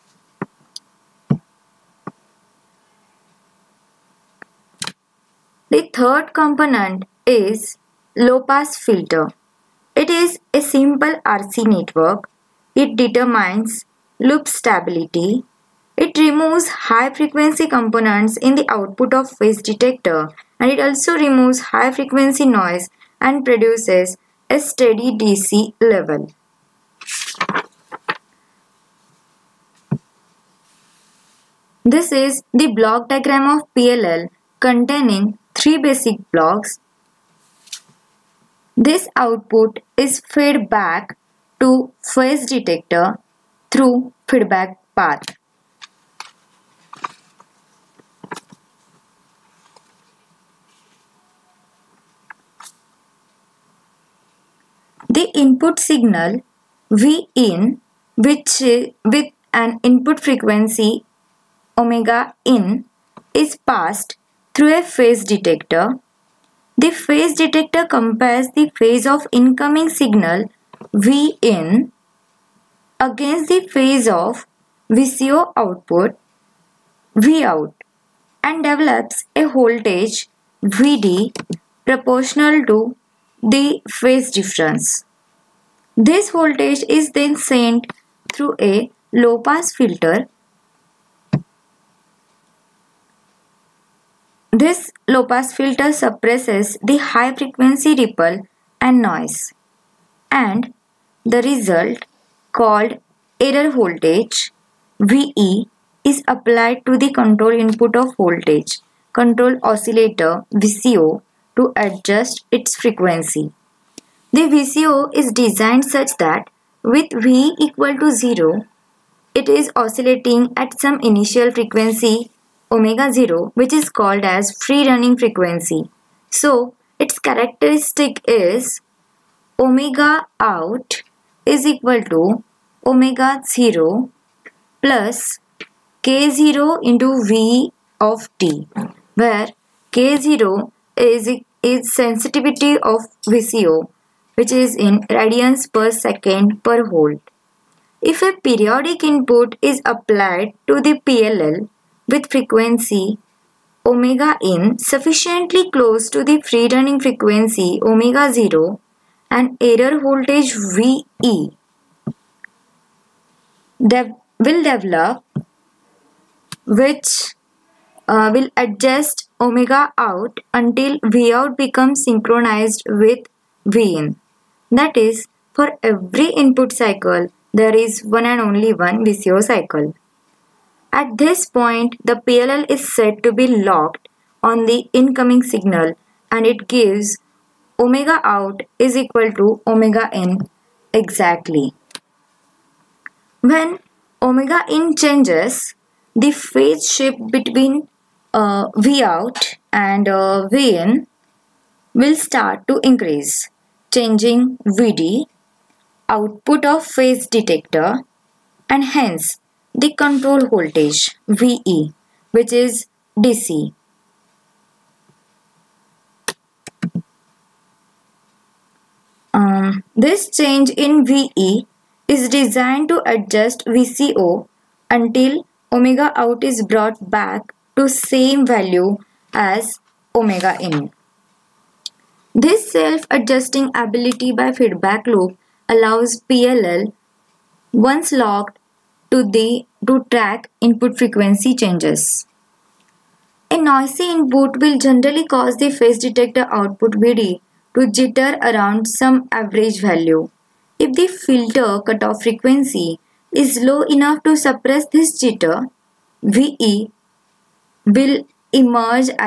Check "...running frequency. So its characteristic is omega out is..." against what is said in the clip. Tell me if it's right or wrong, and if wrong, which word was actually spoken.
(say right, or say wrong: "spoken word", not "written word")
right.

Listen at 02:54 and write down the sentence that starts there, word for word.
That is, for every input cycle, there is one and only one VCO cycle.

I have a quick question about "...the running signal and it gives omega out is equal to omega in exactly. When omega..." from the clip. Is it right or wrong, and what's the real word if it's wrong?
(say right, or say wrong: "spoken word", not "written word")
wrong: "incoming", not "running".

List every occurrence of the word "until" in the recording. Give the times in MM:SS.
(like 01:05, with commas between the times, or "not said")
02:50, 03:44.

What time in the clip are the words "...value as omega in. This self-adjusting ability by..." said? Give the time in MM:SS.
03:48.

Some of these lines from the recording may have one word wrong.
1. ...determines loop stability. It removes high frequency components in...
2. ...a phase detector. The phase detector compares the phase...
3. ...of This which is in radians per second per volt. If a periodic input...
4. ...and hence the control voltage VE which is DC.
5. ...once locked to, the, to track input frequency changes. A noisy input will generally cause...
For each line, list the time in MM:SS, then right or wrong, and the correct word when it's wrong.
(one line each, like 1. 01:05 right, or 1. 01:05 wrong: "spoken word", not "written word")
1. 00:12 right
2. 01:04 right
3. 02:22 wrong: "VCO", not "This"
4. 03:28 right
5. 03:57 right.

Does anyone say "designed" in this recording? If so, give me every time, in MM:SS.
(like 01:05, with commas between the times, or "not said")
01:55, 03:42.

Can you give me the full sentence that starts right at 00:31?
This is the block diagram of PLL containing three basic blocks.